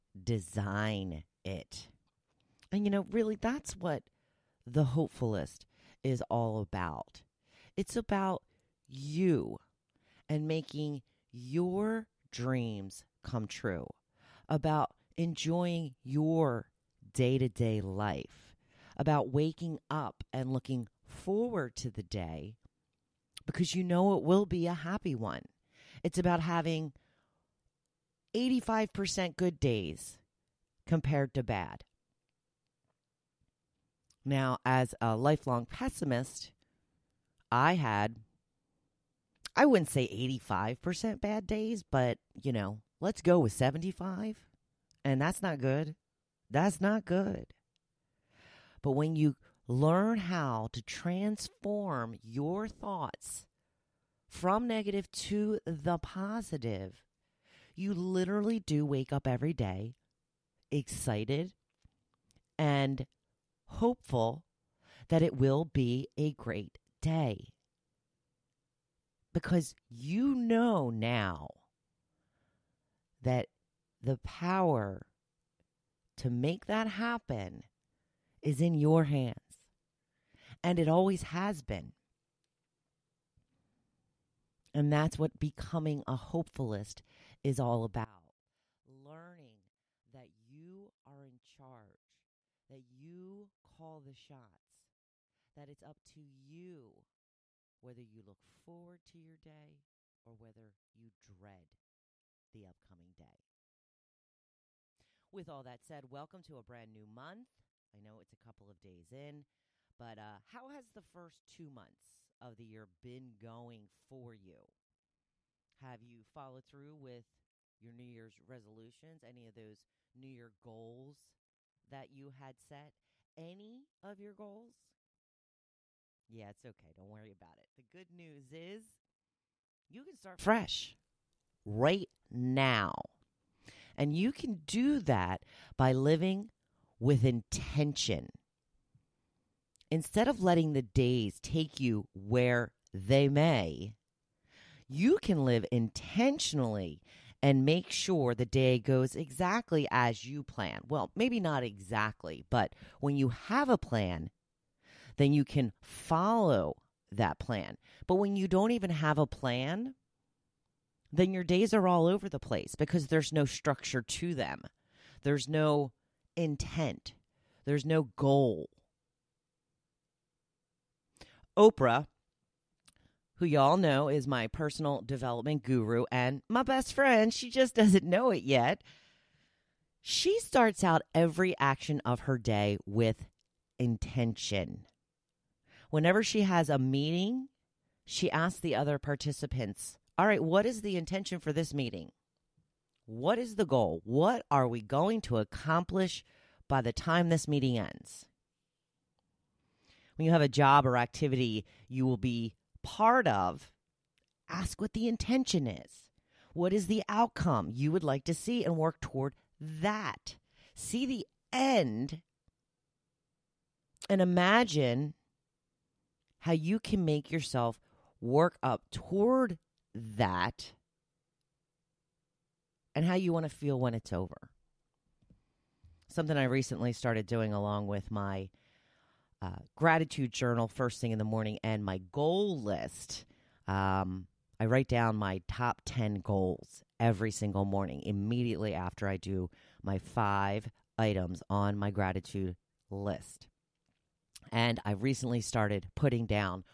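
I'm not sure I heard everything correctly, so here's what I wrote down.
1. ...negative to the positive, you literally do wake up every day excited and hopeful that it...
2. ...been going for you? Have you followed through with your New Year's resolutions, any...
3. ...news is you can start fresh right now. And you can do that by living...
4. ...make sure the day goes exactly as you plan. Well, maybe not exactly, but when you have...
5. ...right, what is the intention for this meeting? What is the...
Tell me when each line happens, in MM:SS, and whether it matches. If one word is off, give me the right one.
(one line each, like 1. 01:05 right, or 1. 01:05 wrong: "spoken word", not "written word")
1. 00:54 right
2. 01:52 right
3. 02:08 right
4. 02:27 right
5. 03:10 right.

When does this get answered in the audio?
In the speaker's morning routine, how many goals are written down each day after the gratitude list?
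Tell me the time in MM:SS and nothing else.
03:55.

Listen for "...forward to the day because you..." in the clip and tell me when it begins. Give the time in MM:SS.
00:21.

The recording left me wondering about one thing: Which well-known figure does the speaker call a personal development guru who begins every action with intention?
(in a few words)
Oprah.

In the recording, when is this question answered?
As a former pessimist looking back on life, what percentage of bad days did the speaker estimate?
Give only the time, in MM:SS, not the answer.
00:43.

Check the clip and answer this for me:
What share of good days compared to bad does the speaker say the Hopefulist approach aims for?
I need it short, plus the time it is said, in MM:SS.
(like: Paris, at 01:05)
85%, at 00:28.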